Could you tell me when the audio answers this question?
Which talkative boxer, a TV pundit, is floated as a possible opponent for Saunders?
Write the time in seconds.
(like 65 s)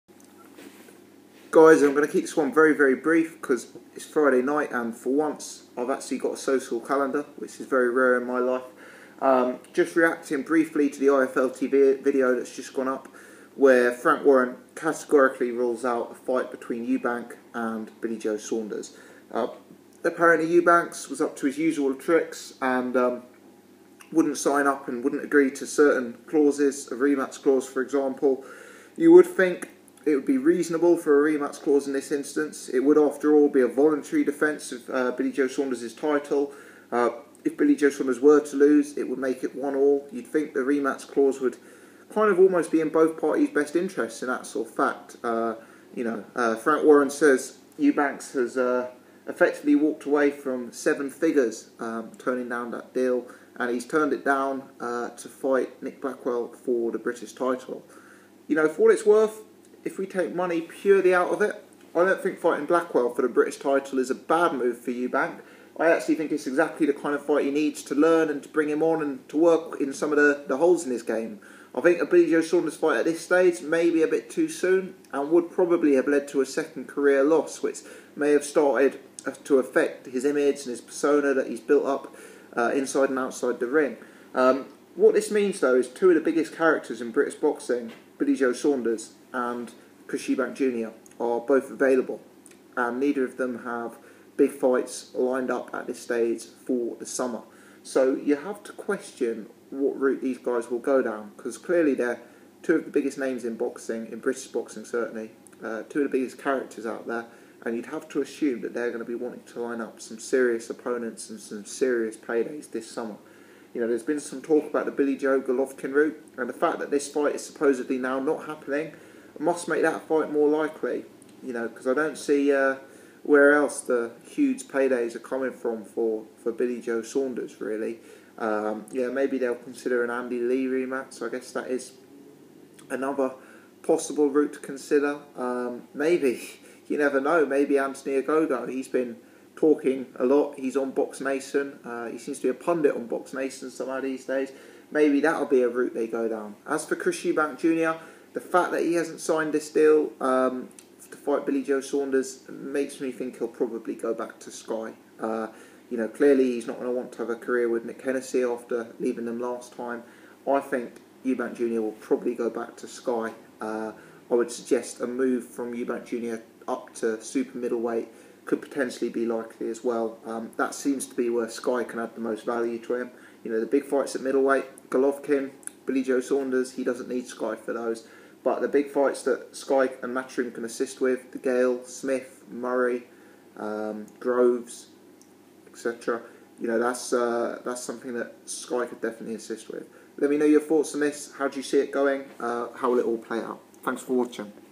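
137 s.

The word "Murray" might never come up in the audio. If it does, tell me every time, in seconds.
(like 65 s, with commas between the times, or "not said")
182 s.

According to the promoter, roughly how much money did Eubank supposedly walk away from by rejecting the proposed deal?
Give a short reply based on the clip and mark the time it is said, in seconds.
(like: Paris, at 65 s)
seven figures, at 50 s.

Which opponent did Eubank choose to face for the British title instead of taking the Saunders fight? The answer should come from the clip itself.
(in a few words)
Nick Blackwell.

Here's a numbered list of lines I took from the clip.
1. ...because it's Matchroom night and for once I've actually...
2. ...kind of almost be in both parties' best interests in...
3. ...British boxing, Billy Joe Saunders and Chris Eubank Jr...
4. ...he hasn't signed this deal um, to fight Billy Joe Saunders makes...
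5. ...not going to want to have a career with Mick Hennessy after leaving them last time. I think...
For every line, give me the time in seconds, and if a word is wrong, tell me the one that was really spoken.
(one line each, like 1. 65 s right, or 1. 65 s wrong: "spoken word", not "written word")
1. 3 s wrong: "Friday", not "Matchroom"
2. 42 s right
3. 87 s right
4. 148 s right
5. 156 s right.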